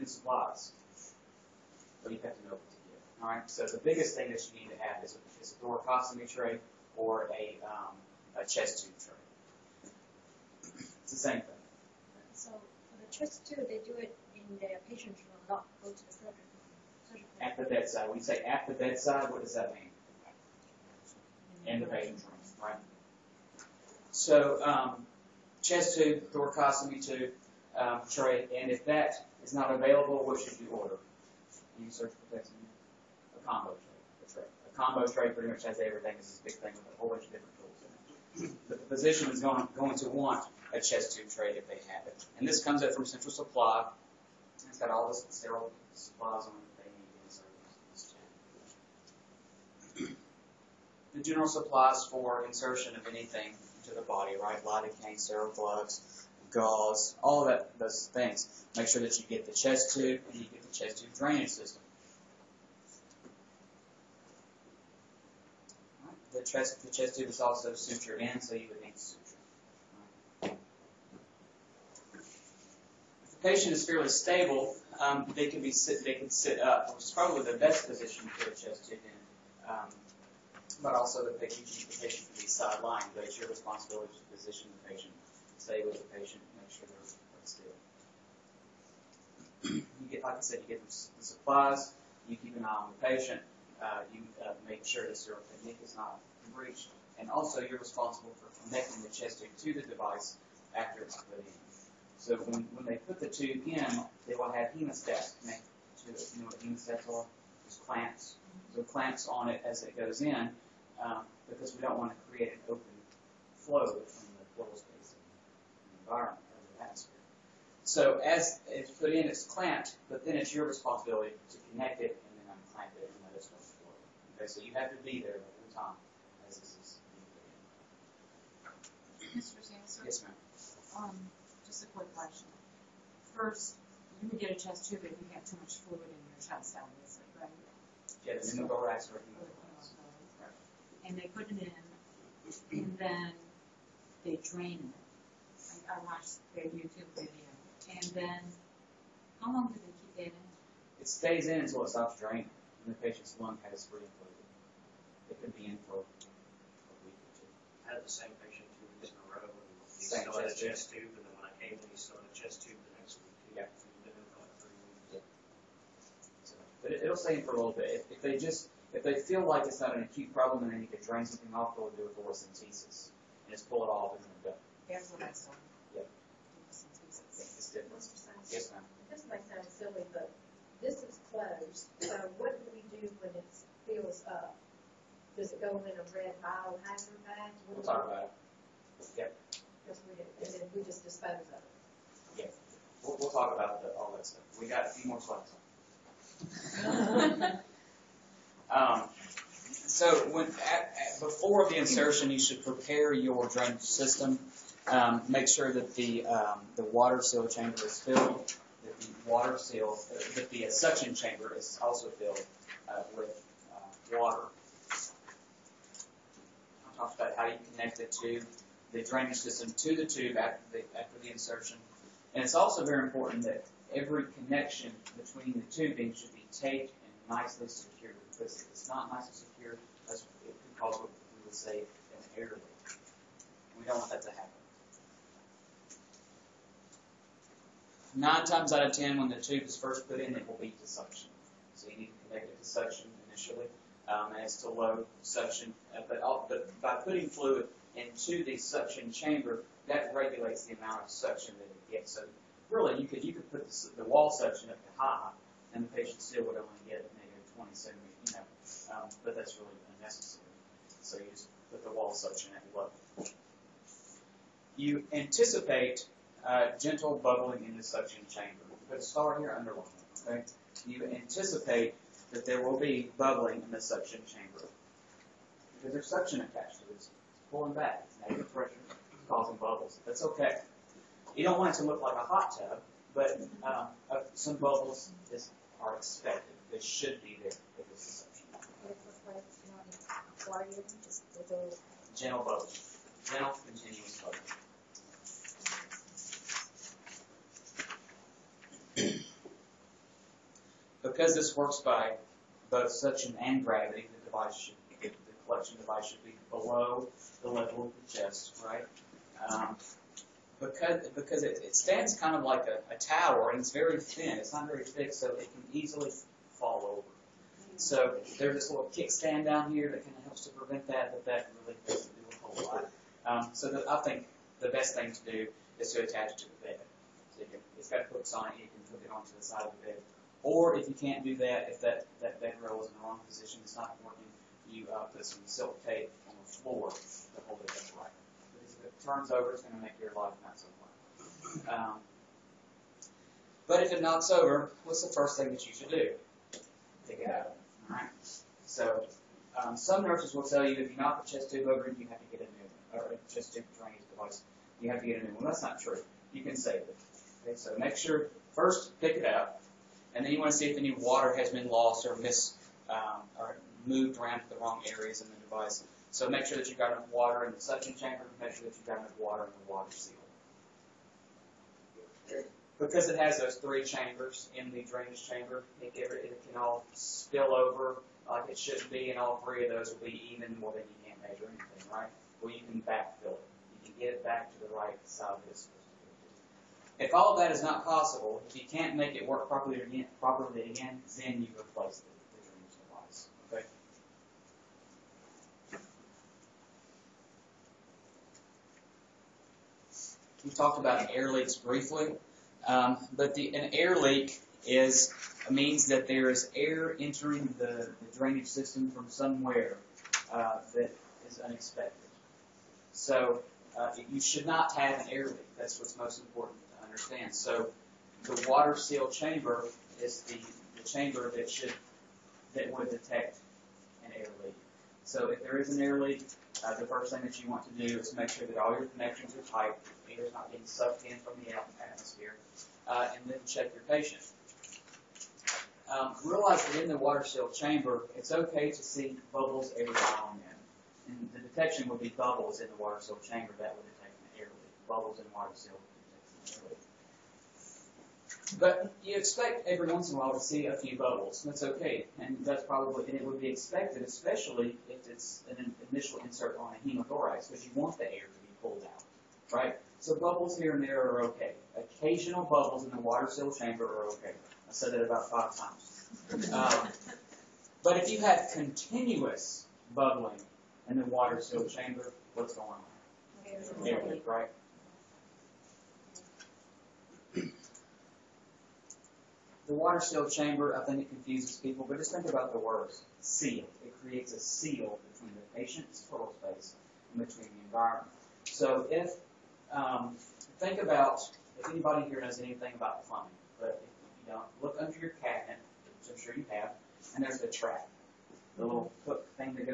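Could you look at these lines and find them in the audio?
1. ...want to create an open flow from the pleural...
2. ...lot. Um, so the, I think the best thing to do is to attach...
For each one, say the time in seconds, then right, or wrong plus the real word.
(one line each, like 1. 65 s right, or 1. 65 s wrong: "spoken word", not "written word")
1. 111 s right
2. 322 s right.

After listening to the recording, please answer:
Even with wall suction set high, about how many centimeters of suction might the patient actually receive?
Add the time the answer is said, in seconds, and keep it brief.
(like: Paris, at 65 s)
20 centimeters, at 257 s.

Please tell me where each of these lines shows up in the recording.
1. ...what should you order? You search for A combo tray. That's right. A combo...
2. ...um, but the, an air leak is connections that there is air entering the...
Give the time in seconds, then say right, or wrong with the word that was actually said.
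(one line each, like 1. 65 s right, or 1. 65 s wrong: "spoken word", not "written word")
1. 30 s right
2. 402 s wrong: "means", not "connections".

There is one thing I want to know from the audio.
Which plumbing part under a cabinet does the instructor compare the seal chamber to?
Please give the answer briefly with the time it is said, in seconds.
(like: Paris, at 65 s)
the trap, at 497 s.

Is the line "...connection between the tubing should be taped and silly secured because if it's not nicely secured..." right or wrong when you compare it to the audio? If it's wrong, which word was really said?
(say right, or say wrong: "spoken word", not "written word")
wrong: "nicely", not "silly".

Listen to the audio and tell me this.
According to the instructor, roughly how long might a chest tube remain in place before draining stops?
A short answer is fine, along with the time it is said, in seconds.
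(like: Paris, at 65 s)
a week or two, at 156 s.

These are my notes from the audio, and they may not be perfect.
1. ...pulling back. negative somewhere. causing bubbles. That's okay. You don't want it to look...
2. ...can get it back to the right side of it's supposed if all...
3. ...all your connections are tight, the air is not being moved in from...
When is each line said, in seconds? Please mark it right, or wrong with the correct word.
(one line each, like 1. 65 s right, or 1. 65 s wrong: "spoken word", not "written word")
1. 277 s wrong: "pressure", not "somewhere"
2. 383 s right
3. 428 s wrong: "sucked", not "moved".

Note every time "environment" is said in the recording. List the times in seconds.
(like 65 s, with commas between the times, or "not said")
116 s, 487 s.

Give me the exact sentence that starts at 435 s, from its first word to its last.
Um, realize that in the water seal chamber, it's okay to see bubbles every now and then.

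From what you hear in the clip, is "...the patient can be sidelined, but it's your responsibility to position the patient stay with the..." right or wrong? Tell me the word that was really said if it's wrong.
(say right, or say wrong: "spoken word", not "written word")
right.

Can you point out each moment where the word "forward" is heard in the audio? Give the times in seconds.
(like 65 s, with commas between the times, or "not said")
123 s.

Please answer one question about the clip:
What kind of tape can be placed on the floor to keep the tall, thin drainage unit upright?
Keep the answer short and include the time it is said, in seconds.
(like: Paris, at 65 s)
silk tape, at 335 s.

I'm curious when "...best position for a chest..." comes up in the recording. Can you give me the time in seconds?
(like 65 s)
77 s.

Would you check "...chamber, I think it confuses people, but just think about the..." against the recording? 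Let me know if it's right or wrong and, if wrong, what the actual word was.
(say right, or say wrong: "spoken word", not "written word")
right.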